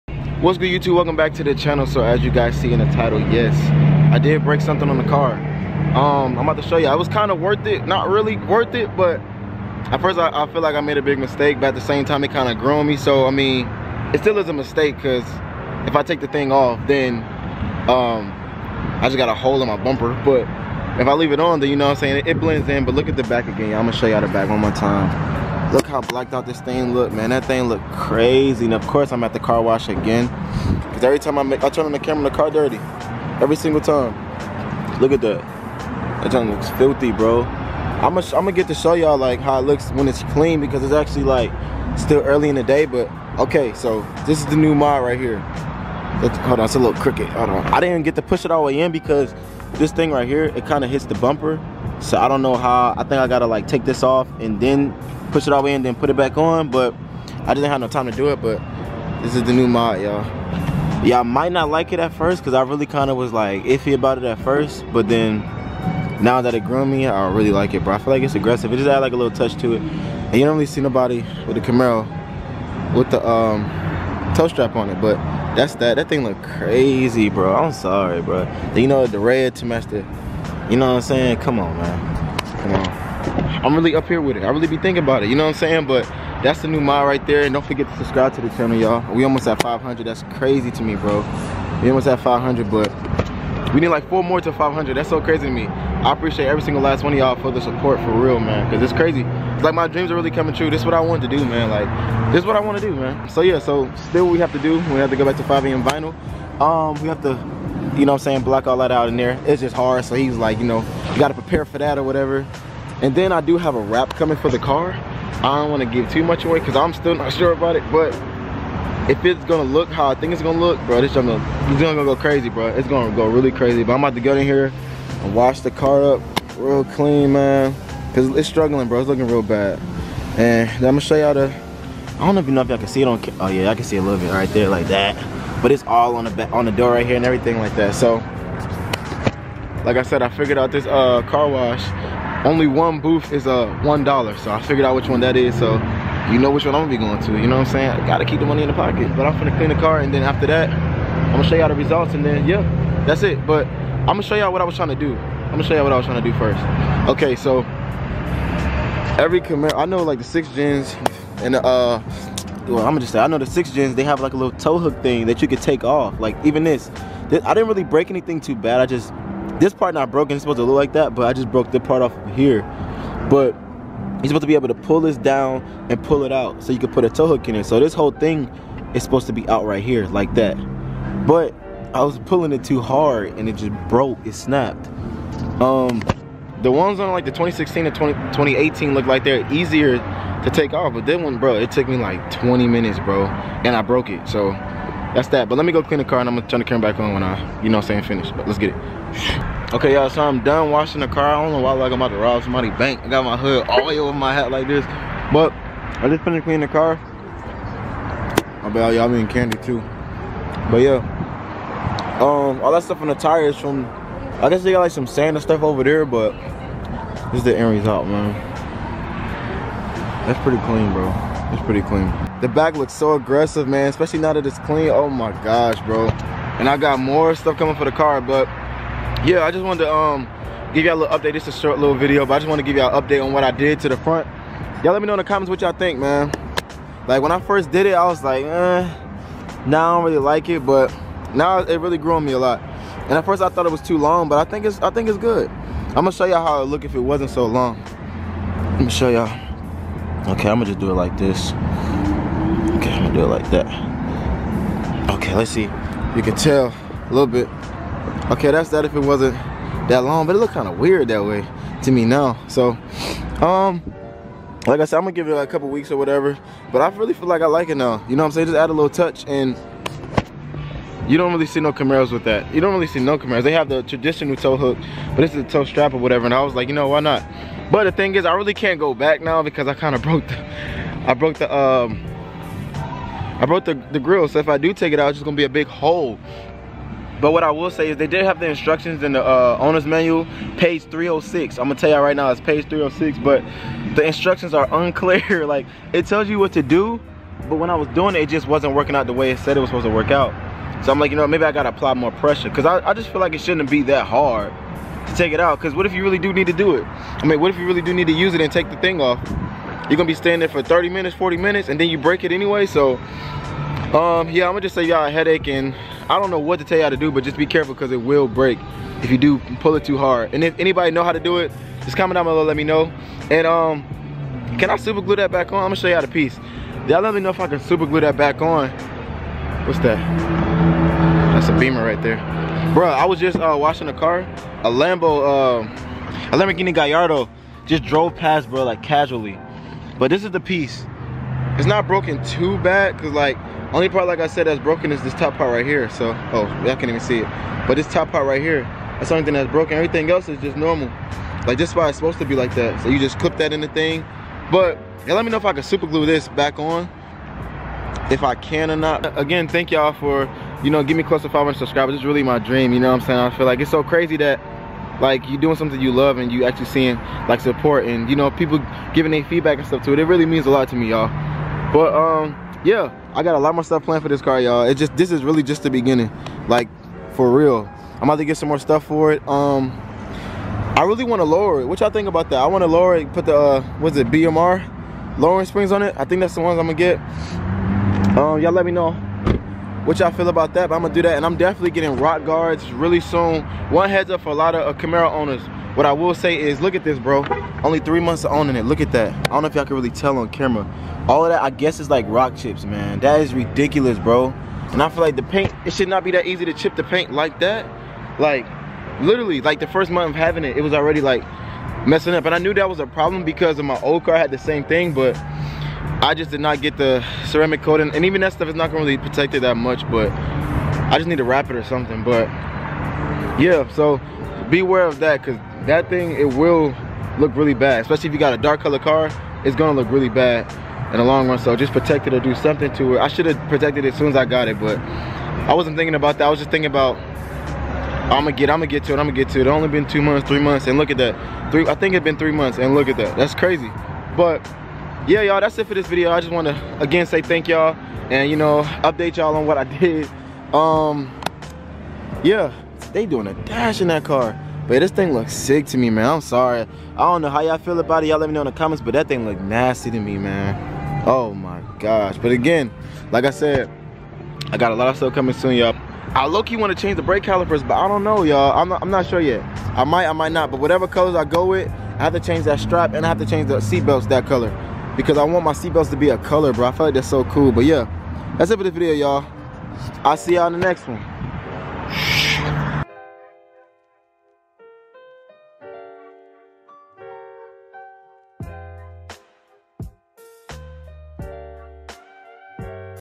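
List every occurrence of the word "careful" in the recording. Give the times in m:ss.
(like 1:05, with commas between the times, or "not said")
5:17.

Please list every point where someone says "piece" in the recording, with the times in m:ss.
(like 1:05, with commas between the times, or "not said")
5:26, 5:40.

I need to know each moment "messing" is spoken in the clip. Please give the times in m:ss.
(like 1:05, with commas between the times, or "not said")
6:51.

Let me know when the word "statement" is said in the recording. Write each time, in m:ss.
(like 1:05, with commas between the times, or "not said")
not said.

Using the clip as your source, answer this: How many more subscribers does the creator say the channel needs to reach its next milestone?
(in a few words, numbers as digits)
4.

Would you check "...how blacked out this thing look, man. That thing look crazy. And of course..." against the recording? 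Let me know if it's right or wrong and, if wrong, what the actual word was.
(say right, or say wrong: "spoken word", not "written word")
right.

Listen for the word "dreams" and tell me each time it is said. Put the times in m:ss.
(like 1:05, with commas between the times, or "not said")
1:39, 6:02.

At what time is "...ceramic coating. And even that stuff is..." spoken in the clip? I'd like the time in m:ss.
6:57.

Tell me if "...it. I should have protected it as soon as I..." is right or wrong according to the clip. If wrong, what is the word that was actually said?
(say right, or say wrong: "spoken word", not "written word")
right.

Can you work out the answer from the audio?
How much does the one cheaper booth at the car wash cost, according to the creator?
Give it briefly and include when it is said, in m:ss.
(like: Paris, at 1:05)
$1, at 2:23.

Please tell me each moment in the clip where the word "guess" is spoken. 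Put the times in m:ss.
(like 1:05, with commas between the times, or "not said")
3:34, 6:41.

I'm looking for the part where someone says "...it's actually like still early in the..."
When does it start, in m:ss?
0:40.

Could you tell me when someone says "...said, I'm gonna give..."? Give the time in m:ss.
4:24.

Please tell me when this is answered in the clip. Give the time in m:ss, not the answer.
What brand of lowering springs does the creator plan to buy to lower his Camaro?
6:24.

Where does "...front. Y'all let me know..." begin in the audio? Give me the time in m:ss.
3:53.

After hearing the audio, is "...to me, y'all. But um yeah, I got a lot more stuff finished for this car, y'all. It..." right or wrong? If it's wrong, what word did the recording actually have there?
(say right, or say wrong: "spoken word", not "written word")
wrong: "planned", not "finished".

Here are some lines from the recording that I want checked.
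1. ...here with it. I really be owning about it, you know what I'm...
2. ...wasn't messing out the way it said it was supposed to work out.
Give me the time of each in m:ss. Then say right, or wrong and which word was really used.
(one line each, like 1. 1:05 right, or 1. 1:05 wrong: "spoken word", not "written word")
1. 1:24 wrong: "thinking", not "owning"
2. 4:58 wrong: "working", not "messing".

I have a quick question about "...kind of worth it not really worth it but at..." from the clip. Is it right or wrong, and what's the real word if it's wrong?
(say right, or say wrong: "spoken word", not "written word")
right.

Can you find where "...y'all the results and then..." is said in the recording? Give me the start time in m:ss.
2:31.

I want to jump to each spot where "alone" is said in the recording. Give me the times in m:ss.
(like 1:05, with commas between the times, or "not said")
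not said.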